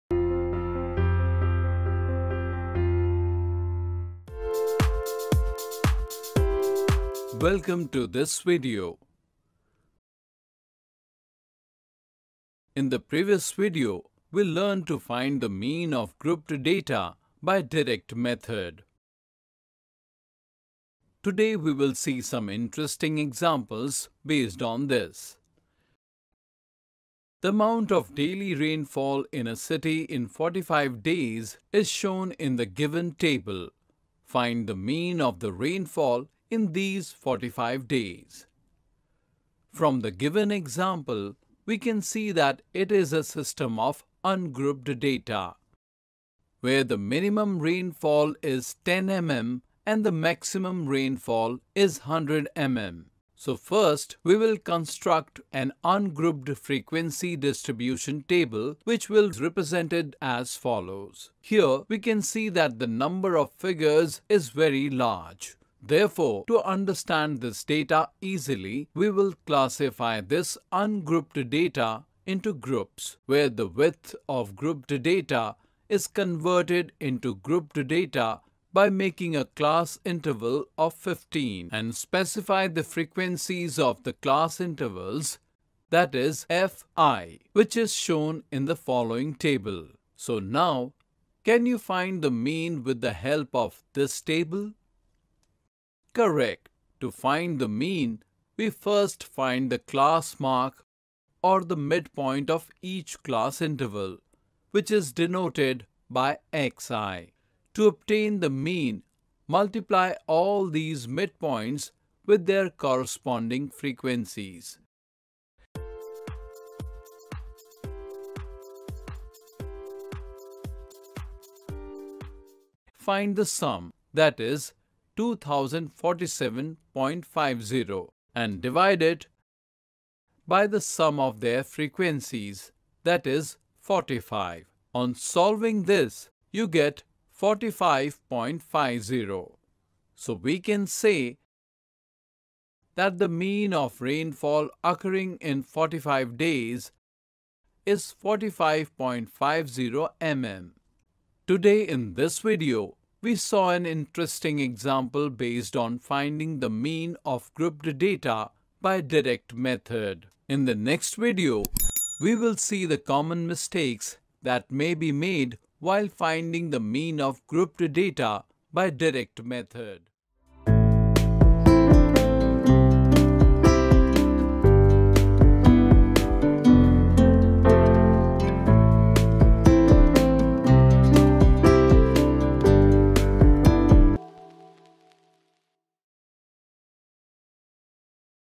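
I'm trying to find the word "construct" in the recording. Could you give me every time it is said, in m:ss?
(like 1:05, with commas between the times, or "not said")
0:54.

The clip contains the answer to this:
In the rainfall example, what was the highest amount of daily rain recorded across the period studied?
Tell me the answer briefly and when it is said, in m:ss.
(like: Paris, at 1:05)
100 mm, at 0:52.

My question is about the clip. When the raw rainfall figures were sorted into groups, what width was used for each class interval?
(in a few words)
15.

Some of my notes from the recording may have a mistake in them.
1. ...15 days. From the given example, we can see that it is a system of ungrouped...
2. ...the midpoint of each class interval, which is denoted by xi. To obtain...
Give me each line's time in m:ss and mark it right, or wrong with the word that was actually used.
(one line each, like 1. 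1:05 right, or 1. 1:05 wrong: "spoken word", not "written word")
1. 0:37 wrong: "45", not "15"
2. 1:41 right.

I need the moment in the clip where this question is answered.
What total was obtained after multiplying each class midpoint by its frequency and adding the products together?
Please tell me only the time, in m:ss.
2:05.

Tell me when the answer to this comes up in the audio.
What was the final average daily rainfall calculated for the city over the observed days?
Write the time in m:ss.
2:28.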